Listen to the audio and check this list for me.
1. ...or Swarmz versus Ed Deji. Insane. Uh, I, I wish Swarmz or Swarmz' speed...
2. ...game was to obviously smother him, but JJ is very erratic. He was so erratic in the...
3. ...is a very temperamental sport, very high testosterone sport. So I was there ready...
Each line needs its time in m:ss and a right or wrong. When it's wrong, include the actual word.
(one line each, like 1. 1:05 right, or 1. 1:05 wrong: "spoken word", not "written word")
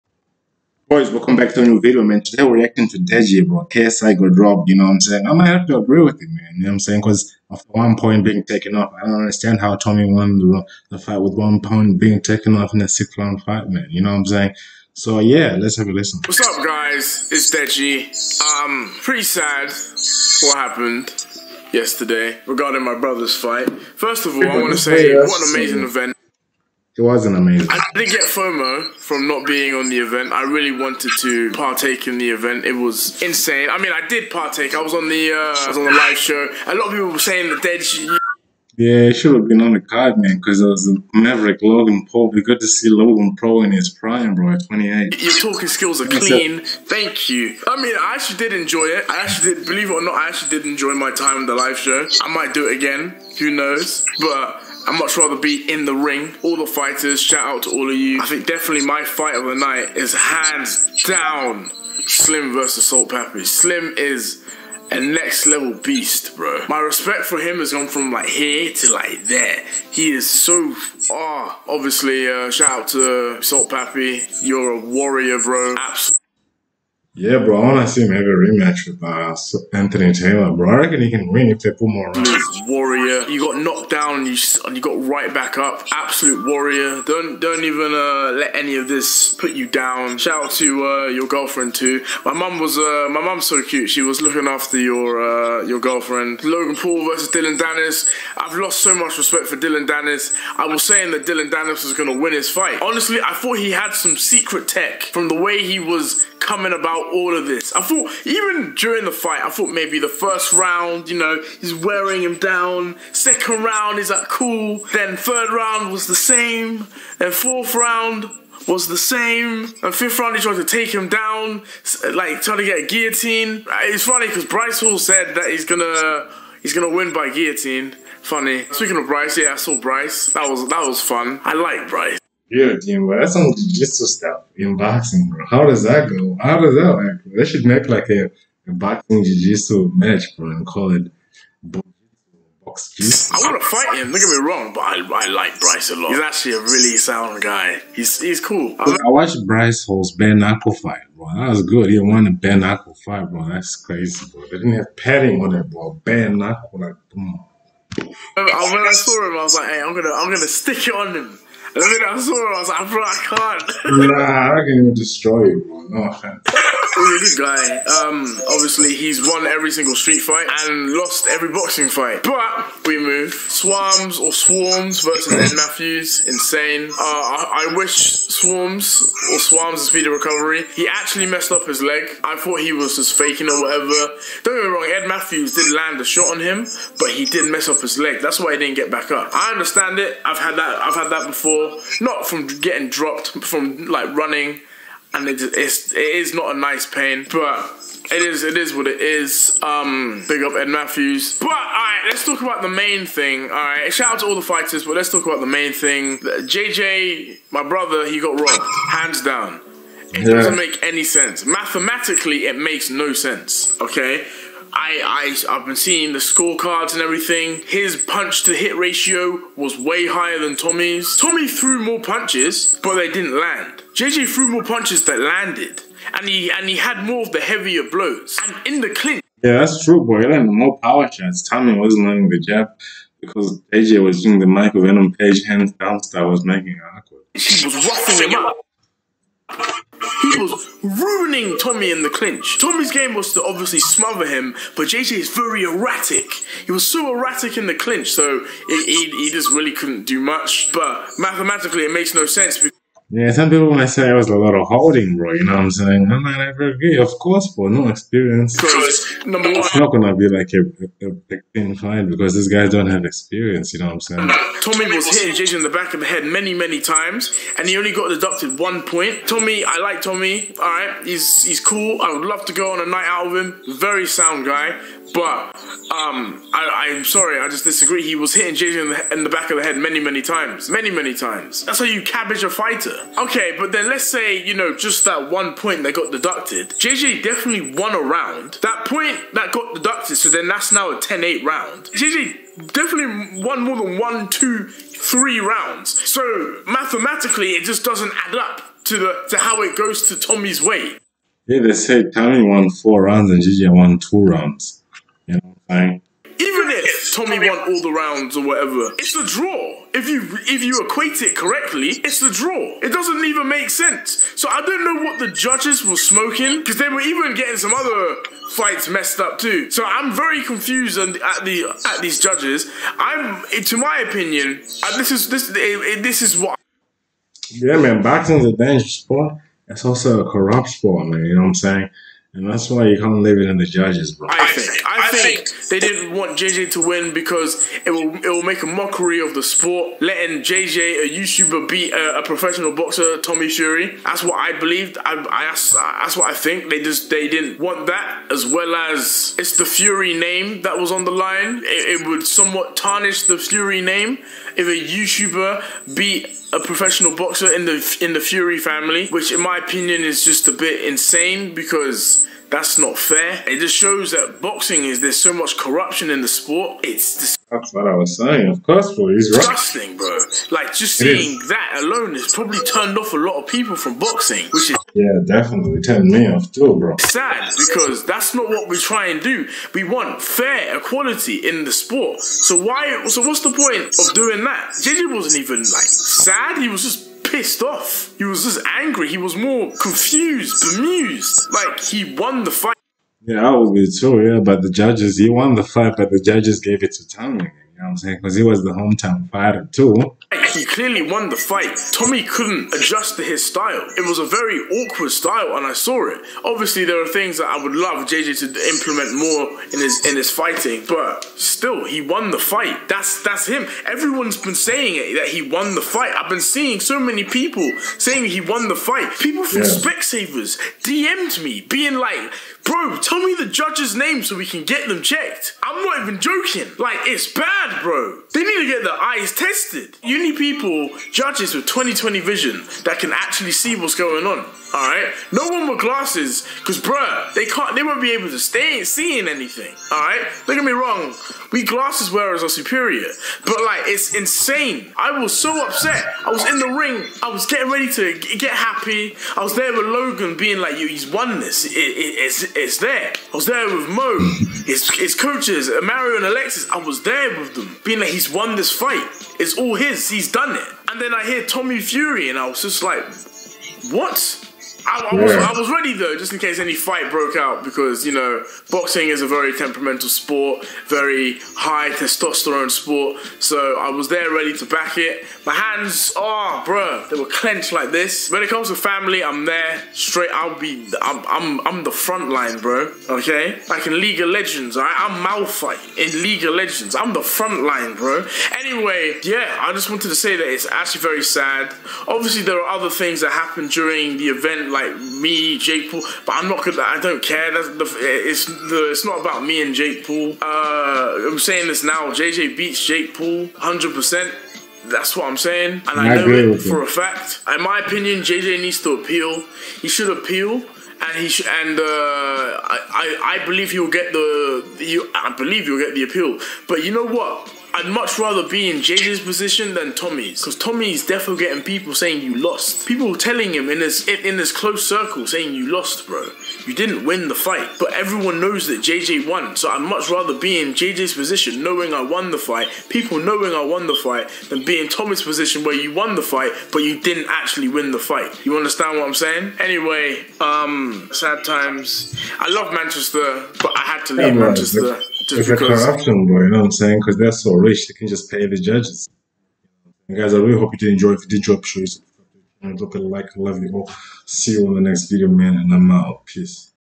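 1. 2:54 wrong: "Matthews", not "Deji"
2. 4:02 right
3. 7:49 right.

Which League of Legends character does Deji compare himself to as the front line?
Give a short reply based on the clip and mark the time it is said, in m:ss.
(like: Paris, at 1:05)
Malphite, at 8:05.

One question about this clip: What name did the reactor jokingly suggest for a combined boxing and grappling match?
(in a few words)
box jiu-jitsu.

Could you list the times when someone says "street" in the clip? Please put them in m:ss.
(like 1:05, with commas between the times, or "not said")
2:49.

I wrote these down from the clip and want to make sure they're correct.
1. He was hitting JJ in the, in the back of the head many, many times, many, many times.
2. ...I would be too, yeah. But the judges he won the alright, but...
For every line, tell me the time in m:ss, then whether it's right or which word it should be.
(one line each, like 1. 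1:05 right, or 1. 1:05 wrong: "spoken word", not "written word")
1. 4:38 right
2. 6:33 wrong: "fight", not "alright".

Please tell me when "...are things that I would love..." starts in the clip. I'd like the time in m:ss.
6:47.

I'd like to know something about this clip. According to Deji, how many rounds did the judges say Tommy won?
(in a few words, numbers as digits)
4.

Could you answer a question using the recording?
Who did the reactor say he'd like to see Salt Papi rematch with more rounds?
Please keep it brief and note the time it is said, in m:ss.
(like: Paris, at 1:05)
Anthony Taylor, at 1:19.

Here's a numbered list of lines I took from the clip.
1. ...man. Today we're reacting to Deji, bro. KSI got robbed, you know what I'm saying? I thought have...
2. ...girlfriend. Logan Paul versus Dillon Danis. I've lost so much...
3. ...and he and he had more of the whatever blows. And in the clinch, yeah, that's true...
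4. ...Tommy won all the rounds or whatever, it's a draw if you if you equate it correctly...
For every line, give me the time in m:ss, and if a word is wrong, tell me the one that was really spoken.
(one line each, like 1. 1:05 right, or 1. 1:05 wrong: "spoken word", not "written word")
1. 0:02 wrong: "might", not "thought"
2. 1:35 right
3. 3:46 wrong: "heavier", not "whatever"
4. 5:07 right.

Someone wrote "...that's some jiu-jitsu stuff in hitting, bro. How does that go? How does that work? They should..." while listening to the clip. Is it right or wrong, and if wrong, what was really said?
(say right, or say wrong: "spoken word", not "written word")
wrong: "boxing", not "hitting".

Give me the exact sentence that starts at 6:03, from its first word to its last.
It just shows that boxing is there's so much corruption in the sport.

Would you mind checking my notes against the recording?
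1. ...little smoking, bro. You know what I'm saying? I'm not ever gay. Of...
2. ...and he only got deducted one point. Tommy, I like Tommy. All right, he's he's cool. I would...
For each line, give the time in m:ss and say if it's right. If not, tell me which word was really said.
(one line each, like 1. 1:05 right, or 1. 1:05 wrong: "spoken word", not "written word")
1. 4:14 wrong: "holding", not "smoking"
2. 4:27 right.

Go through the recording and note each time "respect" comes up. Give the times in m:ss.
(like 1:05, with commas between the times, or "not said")
1:06, 1:39.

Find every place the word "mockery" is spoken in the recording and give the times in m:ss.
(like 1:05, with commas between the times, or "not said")
5:38.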